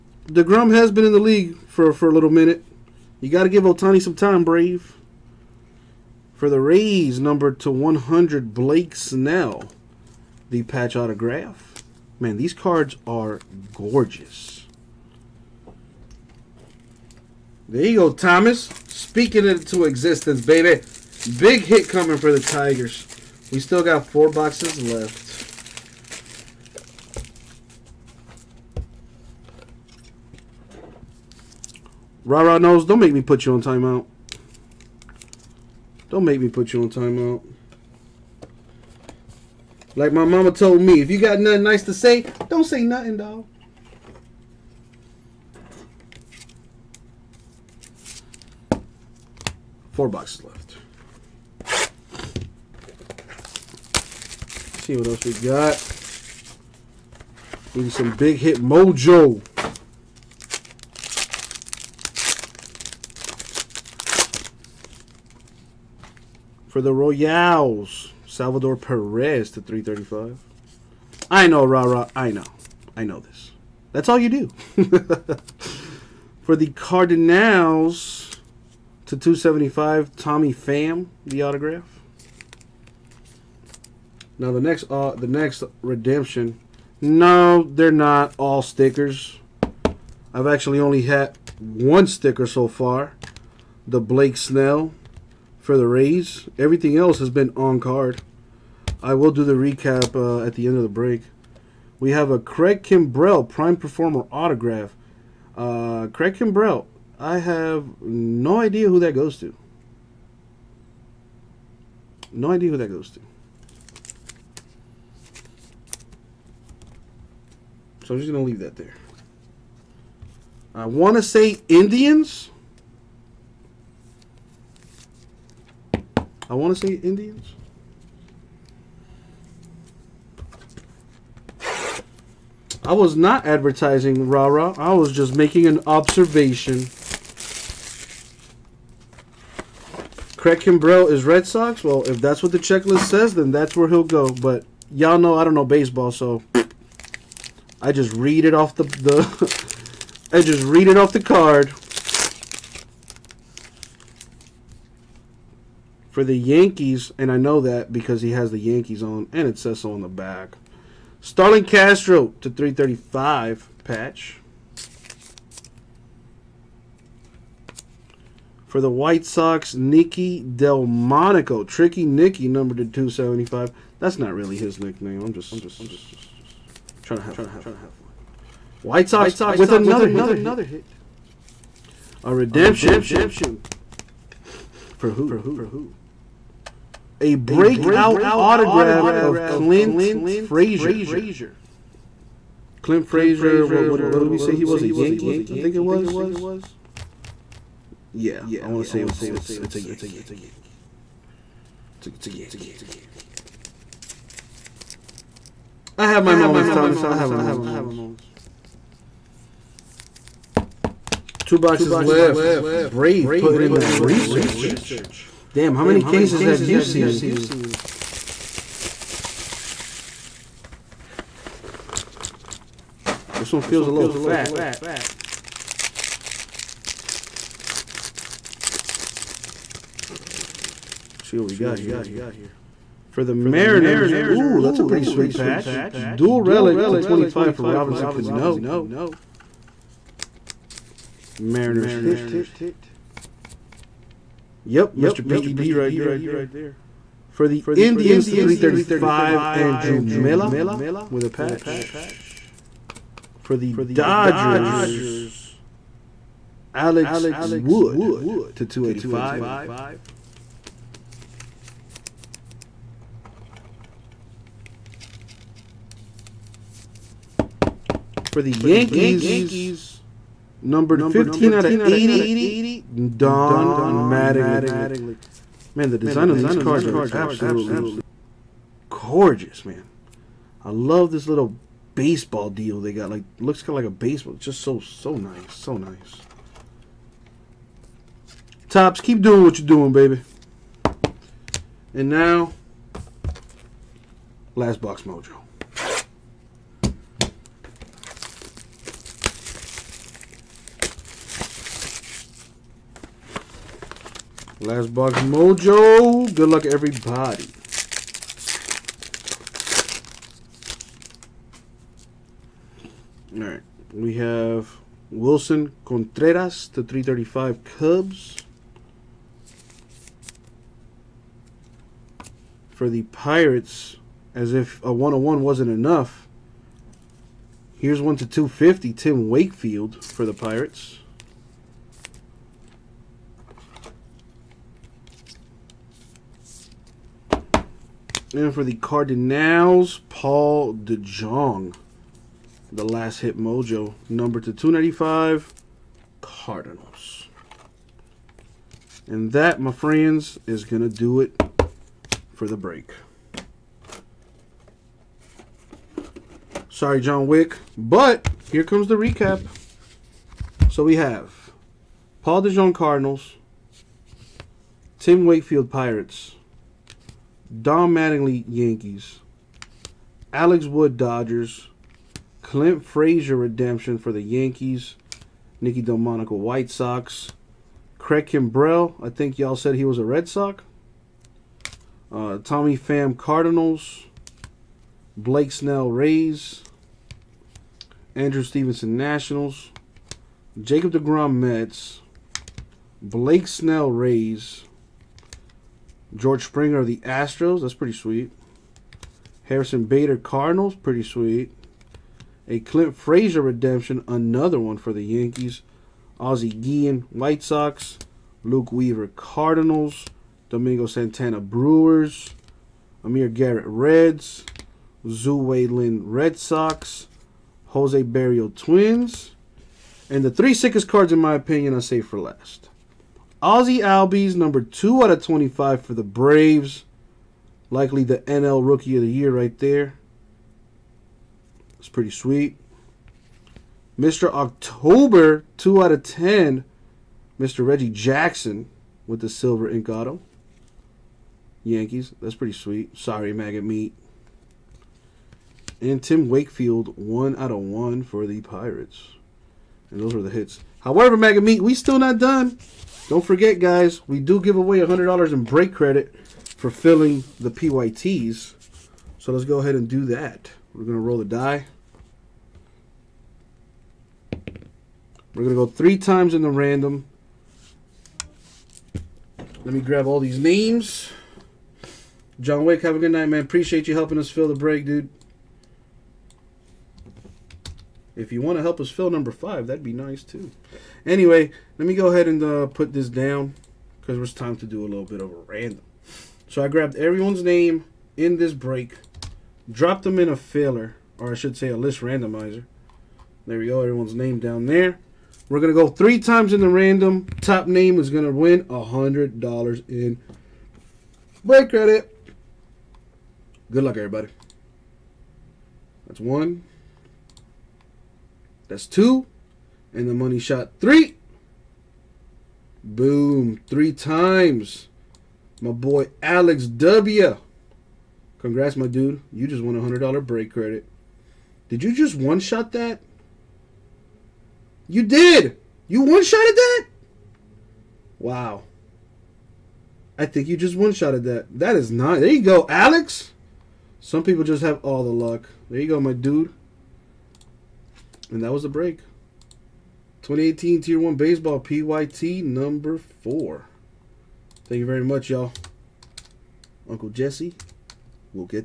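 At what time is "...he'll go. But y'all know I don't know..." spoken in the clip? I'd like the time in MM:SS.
02:23.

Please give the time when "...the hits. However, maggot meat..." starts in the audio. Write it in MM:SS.
07:30.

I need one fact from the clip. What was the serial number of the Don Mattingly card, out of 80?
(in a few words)
15.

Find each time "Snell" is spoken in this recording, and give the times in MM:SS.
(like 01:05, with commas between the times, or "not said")
00:08, 01:34, 06:25, 06:33.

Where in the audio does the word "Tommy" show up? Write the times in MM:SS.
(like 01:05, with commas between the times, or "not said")
01:20, 06:22.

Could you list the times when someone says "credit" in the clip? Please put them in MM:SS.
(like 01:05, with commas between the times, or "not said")
07:35, 08:21, 08:40.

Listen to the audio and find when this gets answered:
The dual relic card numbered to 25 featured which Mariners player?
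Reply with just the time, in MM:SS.
03:57.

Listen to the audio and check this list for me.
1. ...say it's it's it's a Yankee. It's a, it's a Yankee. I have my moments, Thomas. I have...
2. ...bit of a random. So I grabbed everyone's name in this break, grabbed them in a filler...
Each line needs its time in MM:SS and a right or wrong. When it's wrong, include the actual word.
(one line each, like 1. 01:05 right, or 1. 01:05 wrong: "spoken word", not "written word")
1. 03:18 right
2. 08:05 wrong: "dropped", not "grabbed".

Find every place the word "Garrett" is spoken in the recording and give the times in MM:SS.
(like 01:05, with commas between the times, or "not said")
06:53.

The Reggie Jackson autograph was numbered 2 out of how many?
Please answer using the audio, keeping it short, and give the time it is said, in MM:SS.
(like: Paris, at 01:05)
10, at 07:16.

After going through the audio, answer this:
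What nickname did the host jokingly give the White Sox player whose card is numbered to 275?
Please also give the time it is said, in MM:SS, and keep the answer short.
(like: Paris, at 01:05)
Tricky Nicky, at 02:51.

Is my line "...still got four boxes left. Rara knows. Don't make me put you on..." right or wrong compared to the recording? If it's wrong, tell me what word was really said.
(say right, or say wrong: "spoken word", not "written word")
right.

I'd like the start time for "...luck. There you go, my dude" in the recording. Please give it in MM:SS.
08:55.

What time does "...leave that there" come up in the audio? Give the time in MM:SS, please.
01:58.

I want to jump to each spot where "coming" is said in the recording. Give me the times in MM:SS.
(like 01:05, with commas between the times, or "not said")
00:21.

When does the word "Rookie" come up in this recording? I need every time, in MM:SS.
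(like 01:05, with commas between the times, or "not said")
07:08.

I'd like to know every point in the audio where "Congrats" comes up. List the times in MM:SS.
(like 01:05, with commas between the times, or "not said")
08:38.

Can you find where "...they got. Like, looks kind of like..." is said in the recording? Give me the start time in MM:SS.
04:42.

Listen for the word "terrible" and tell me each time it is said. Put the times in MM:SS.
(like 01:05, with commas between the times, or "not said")
not said.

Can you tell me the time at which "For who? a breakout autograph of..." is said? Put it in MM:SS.
03:04.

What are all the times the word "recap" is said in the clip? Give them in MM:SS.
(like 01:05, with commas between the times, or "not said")
01:39, 05:58.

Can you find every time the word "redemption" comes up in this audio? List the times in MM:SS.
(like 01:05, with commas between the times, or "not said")
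01:25, 03:02, 06:13, 06:43.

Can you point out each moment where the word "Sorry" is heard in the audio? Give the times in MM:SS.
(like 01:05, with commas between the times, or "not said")
05:56, 07:22.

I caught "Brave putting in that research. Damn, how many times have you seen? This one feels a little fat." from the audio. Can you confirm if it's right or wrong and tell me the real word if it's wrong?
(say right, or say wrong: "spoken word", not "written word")
wrong: "cases", not "times".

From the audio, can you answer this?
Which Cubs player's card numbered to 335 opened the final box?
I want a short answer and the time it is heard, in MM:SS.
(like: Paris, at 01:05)
Willson Contreras, at 05:15.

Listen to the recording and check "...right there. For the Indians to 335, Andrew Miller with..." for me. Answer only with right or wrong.
right.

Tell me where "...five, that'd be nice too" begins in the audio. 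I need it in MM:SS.
07:59.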